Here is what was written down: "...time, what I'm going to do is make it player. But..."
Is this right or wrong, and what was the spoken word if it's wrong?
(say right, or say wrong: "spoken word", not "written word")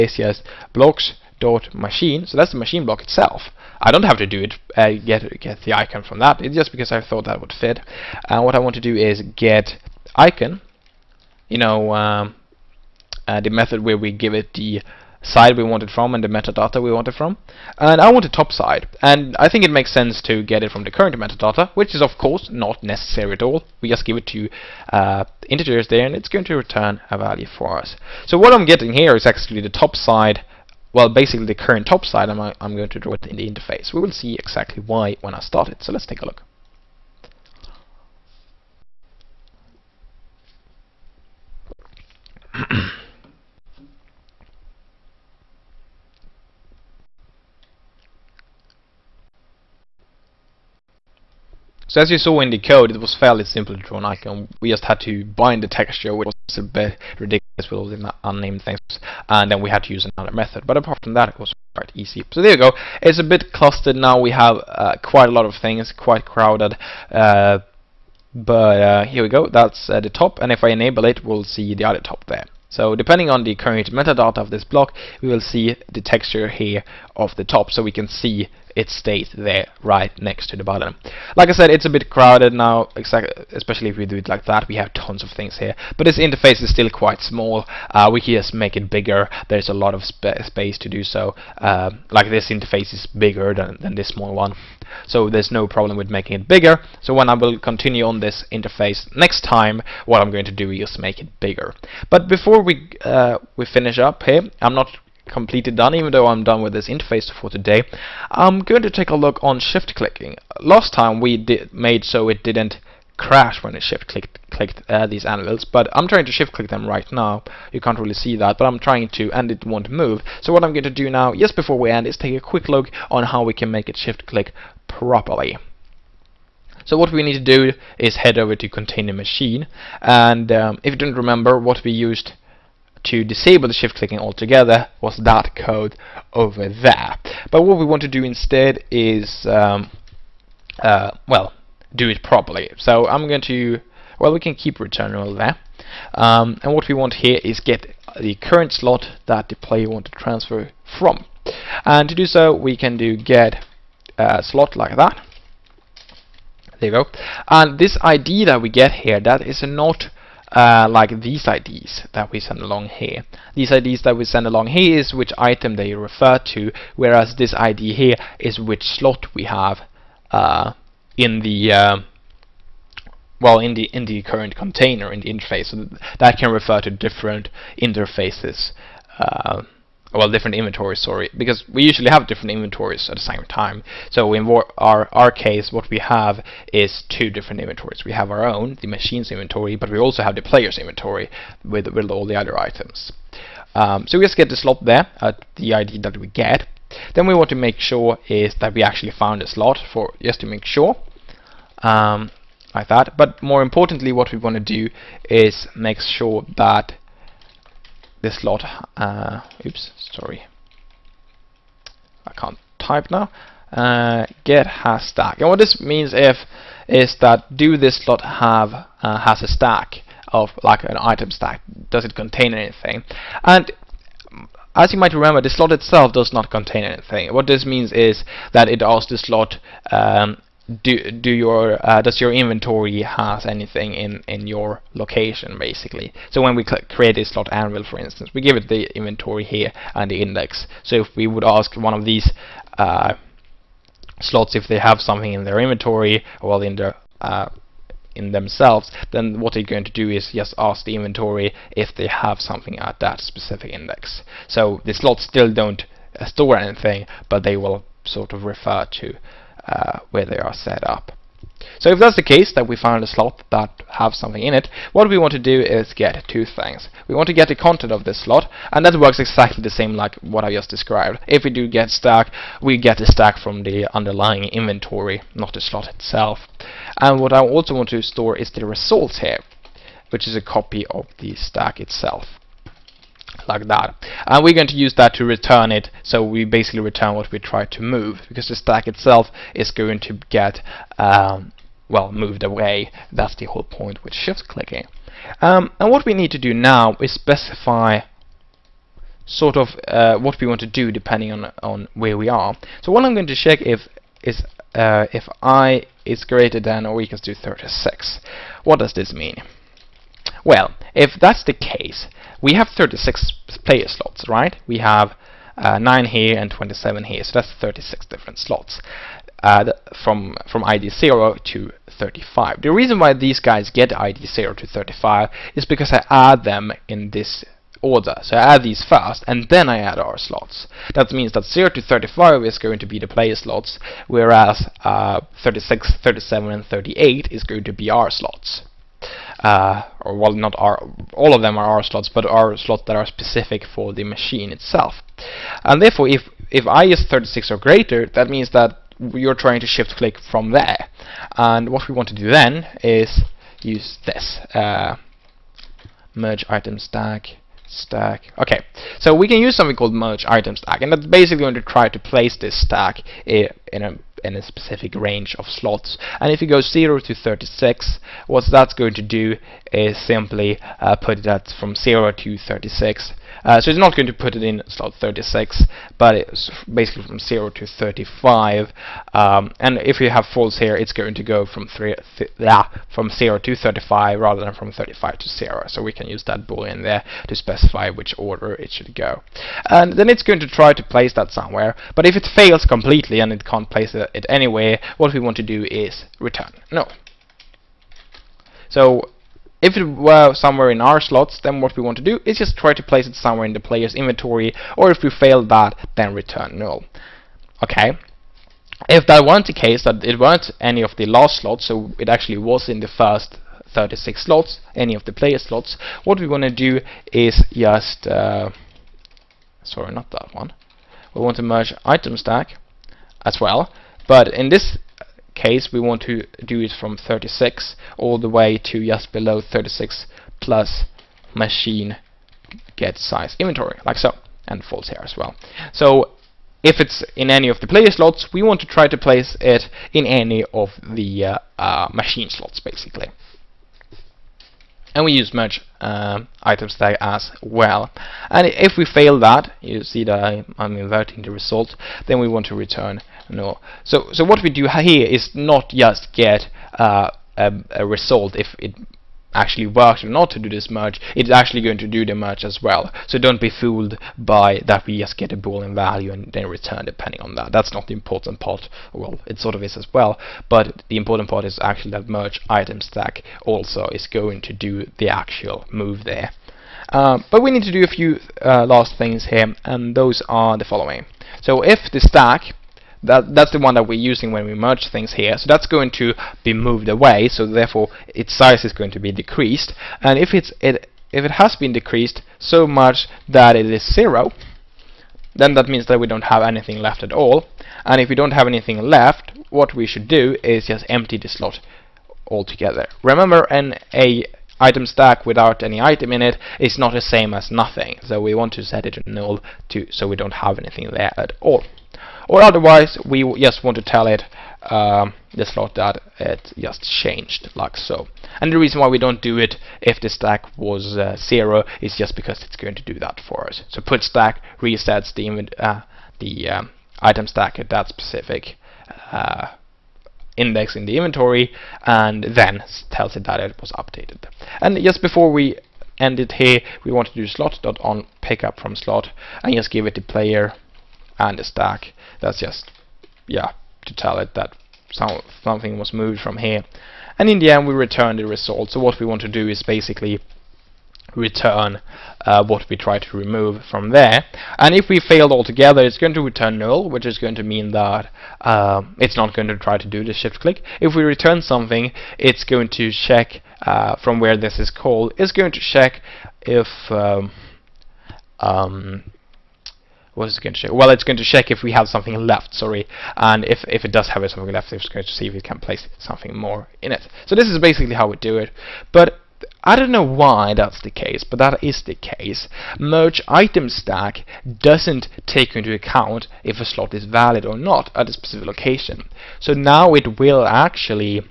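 wrong: "bigger", not "player".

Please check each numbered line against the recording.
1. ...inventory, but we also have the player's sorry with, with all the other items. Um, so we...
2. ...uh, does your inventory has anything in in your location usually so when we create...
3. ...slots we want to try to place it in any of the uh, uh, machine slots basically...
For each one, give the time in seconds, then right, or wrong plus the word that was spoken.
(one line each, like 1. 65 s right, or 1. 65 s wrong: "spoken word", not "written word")
1. 189 s wrong: "inventory", not "sorry"
2. 231 s wrong: "basically", not "usually"
3. 437 s right.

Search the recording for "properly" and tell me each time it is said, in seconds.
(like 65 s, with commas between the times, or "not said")
124 s, 142 s.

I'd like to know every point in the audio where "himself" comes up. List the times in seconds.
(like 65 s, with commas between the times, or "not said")
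not said.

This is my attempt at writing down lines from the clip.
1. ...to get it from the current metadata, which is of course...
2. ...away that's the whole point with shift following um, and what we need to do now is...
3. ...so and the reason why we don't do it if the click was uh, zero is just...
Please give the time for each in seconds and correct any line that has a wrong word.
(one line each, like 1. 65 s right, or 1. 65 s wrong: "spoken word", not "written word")
1. 20 s right
2. 292 s wrong: "clicking", not "following"
3. 517 s wrong: "stack", not "click".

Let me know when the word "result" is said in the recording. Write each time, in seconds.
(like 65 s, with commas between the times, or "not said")
278 s, 451 s, 457 s, 548 s.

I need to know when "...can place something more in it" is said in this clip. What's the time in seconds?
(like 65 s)
575 s.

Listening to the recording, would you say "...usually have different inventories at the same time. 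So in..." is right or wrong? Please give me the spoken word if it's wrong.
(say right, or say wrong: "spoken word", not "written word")
right.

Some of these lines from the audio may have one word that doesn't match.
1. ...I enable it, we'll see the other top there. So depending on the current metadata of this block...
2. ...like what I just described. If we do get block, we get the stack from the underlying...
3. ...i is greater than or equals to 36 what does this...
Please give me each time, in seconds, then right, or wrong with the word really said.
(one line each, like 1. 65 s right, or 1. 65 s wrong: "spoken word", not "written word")
1. 70 s right
2. 269 s wrong: "stack", not "block"
3. 305 s right.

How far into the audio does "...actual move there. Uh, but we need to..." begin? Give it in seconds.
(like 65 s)
475 s.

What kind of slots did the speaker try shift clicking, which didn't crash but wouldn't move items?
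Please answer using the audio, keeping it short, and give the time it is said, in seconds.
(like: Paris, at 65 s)
Anvils, at 115 s.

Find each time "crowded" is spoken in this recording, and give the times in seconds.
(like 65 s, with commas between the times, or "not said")
66 s, 82 s.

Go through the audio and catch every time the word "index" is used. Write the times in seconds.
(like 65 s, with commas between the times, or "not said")
240 s, 253 s, 530 s.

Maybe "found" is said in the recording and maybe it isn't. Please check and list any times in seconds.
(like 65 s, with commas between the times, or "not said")
199 s, 262 s.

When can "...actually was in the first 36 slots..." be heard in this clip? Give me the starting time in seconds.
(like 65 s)
412 s.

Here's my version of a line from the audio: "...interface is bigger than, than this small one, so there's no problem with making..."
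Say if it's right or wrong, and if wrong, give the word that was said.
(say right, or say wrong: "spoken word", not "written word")
right.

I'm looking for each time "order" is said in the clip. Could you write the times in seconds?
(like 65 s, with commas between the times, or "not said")
327 s, 388 s.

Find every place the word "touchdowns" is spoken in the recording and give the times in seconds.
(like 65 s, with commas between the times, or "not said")
not said.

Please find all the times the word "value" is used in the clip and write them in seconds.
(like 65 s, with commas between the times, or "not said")
27 s, 465 s.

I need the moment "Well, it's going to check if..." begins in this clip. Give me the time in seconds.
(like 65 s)
570 s.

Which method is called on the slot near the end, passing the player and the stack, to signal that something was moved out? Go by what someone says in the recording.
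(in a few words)
on pickup from slot.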